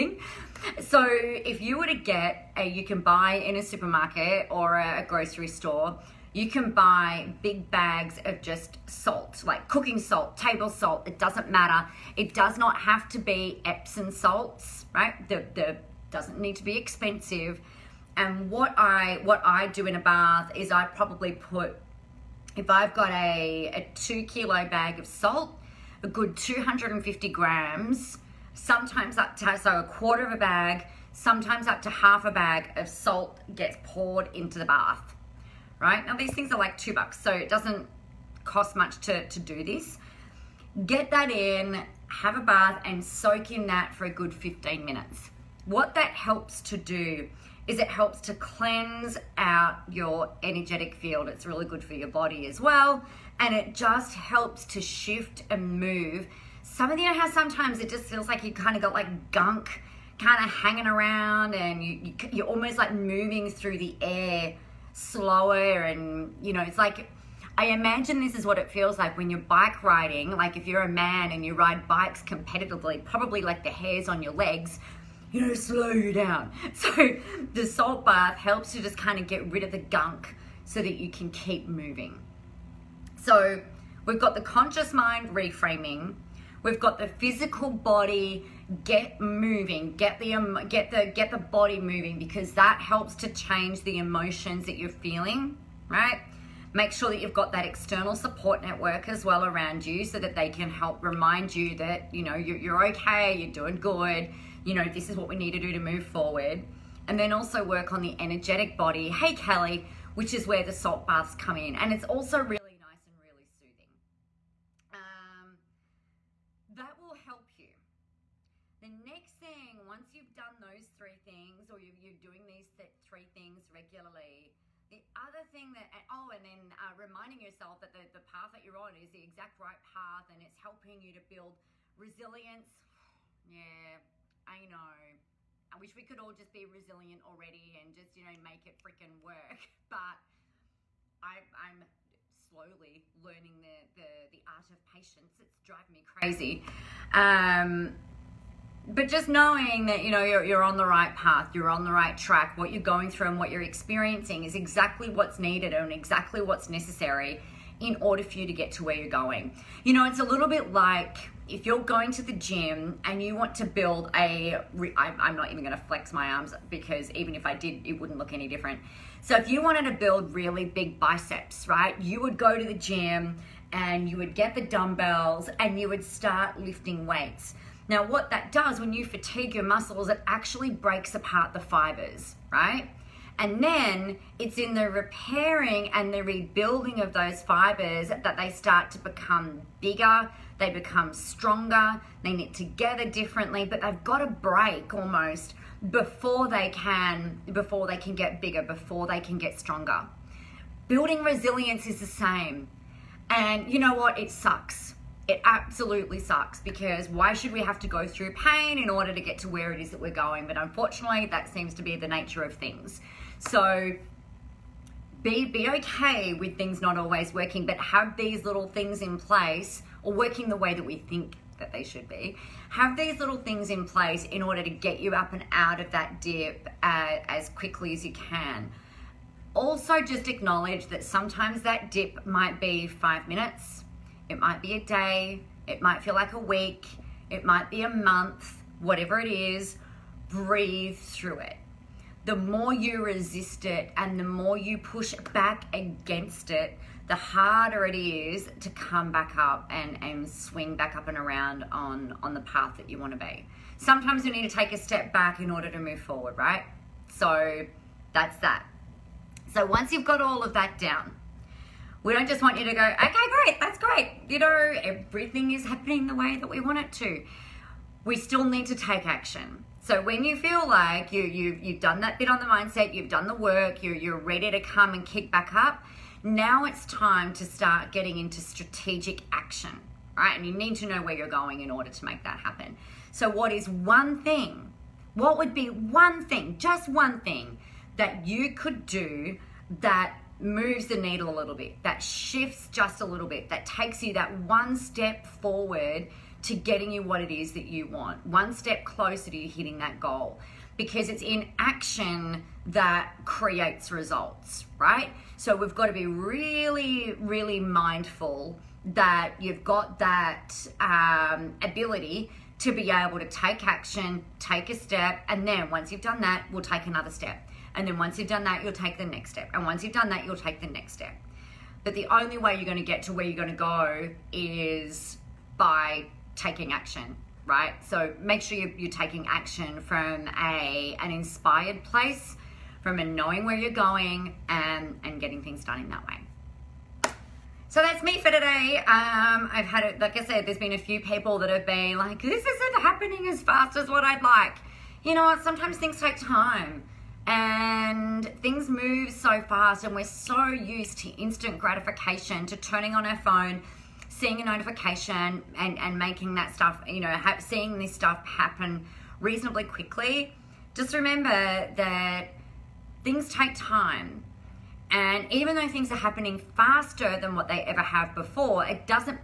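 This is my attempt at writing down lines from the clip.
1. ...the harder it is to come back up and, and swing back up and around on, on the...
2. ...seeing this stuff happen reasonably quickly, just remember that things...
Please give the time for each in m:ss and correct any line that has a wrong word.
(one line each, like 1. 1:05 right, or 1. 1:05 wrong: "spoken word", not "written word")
1. 4:07 right
2. 5:57 right.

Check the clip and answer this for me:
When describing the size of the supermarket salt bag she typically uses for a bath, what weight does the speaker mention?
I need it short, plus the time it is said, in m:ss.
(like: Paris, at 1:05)
2 kilos, at 0:23.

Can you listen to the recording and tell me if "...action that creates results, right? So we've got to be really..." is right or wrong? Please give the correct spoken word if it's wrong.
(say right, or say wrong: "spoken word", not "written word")
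right.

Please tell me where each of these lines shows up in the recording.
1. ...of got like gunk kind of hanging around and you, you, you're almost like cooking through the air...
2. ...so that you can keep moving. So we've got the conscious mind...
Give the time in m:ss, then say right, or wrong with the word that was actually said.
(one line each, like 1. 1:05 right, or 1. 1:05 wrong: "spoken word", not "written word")
1. 0:58 wrong: "moving", not "cooking"
2. 1:20 right.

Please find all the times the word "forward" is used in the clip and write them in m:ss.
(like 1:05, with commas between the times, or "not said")
1:46, 4:15, 4:55.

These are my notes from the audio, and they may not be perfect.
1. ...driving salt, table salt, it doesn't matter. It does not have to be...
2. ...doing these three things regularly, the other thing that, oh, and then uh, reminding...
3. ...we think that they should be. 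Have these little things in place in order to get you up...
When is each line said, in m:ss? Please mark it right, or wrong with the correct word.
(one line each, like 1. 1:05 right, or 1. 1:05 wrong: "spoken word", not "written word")
1. 0:09 wrong: "cooking", not "driving"
2. 2:02 right
3. 3:40 right.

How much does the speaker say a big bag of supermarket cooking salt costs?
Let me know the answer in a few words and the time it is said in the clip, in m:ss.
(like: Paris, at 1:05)
2 bucks, at 0:36.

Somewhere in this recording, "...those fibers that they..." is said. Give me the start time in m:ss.
3:07.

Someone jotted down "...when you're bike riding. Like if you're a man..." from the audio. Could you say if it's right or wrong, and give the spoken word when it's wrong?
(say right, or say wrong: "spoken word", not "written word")
right.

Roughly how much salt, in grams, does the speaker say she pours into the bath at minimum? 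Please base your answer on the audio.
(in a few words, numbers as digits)
250 grams.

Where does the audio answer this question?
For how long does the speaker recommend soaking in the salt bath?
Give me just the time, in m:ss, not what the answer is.
0:44.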